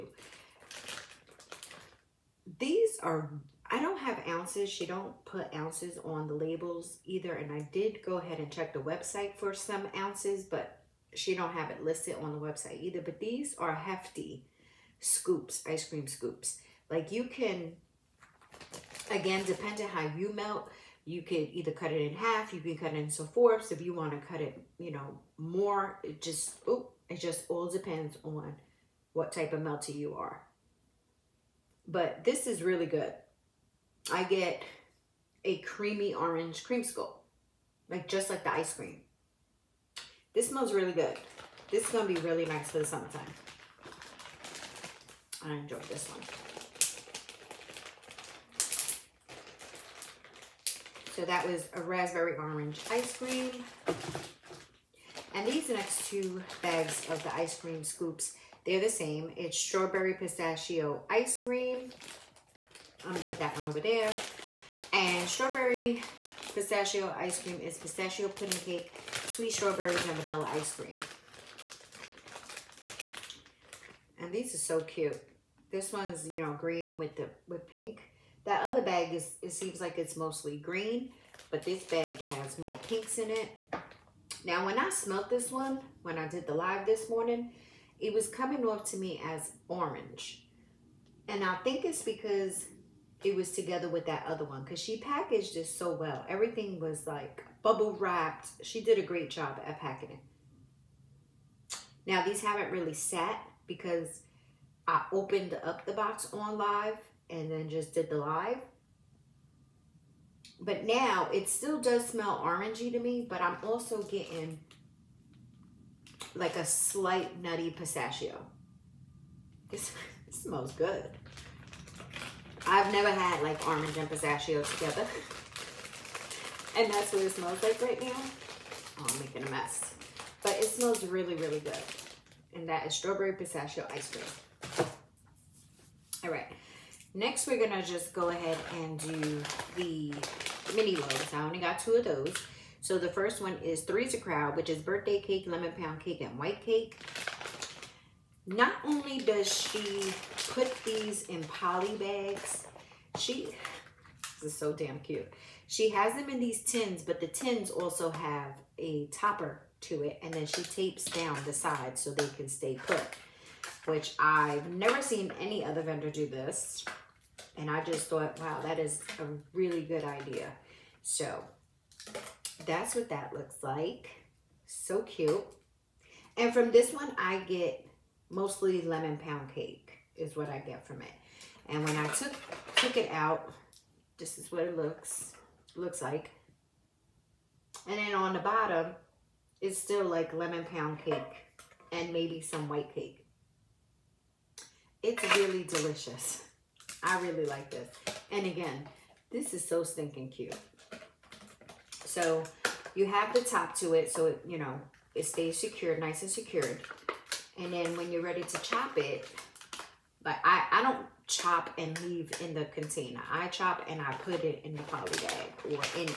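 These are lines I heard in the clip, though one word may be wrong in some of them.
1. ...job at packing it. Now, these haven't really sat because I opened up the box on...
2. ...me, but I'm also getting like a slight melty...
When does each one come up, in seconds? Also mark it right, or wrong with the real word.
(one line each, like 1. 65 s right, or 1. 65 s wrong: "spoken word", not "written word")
1. 99 s right
2. 112 s wrong: "nutty", not "melty".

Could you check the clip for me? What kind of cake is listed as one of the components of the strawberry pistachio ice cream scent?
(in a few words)
Pistachio pudding cake.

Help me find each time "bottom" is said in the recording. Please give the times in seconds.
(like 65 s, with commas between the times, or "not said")
188 s.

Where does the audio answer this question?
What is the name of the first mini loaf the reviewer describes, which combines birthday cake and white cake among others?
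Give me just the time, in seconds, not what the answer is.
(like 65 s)
143 s.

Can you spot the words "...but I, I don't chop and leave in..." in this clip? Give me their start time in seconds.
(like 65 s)
210 s.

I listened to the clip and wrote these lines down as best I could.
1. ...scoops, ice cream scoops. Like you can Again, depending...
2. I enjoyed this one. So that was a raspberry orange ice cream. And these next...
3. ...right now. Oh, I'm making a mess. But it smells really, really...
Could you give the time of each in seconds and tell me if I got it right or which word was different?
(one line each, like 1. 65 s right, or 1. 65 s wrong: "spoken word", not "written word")
1. 14 s right
2. 45 s right
3. 127 s right.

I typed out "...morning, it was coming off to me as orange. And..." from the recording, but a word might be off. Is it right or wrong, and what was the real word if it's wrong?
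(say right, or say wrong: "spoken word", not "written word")
right.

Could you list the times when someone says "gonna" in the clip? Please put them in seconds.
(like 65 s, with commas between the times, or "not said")
63 s, 137 s.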